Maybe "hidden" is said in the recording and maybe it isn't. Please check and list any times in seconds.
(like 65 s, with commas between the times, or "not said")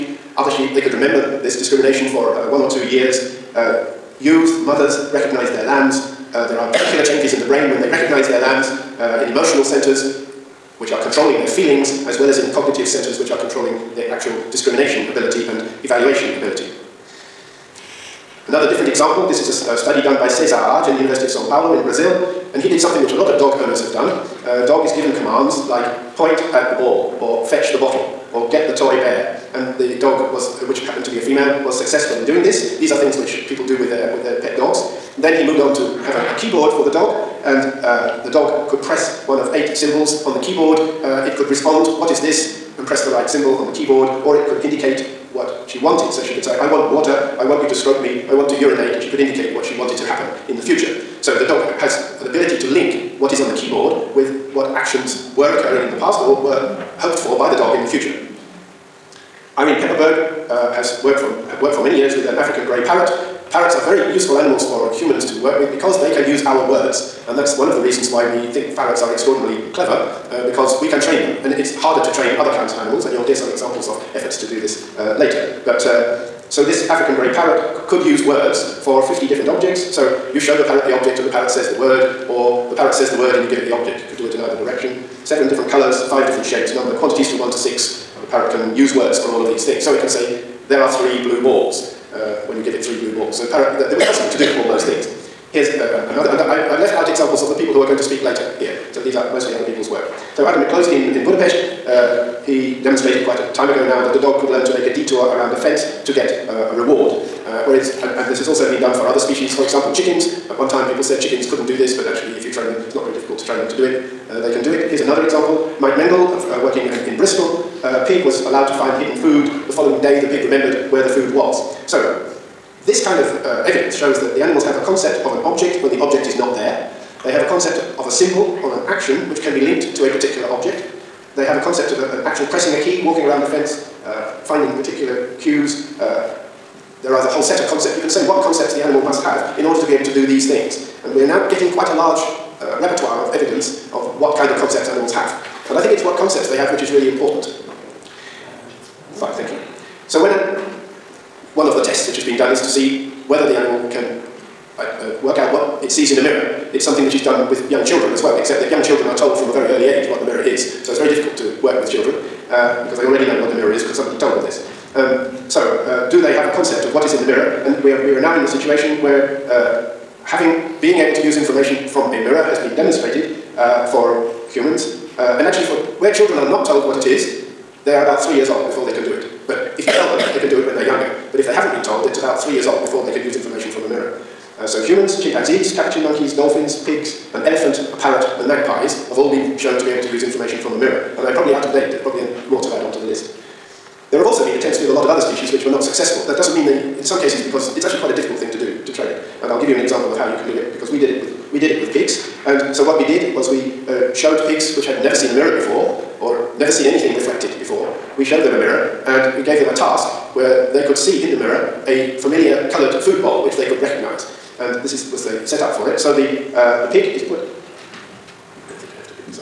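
119 s.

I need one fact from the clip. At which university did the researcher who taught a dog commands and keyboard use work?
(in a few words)
University of Sao Paulo.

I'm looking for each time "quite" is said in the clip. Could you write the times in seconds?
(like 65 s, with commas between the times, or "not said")
103 s, 141 s, 198 s.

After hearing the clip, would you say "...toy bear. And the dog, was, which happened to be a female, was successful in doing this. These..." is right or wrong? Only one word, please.
right.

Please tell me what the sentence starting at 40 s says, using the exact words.
Uh, it could respond, what is this, and press the right symbol on the keyboard, or it could indicate what she wanted.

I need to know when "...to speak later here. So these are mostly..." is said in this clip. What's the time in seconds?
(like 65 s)
97 s.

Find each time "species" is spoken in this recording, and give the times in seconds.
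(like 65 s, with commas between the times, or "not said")
109 s, 195 s.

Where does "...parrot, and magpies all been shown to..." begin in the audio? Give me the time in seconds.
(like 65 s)
187 s.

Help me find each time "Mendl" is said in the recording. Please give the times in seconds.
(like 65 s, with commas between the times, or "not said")
115 s.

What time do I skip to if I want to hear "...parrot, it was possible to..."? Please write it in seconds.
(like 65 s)
93 s.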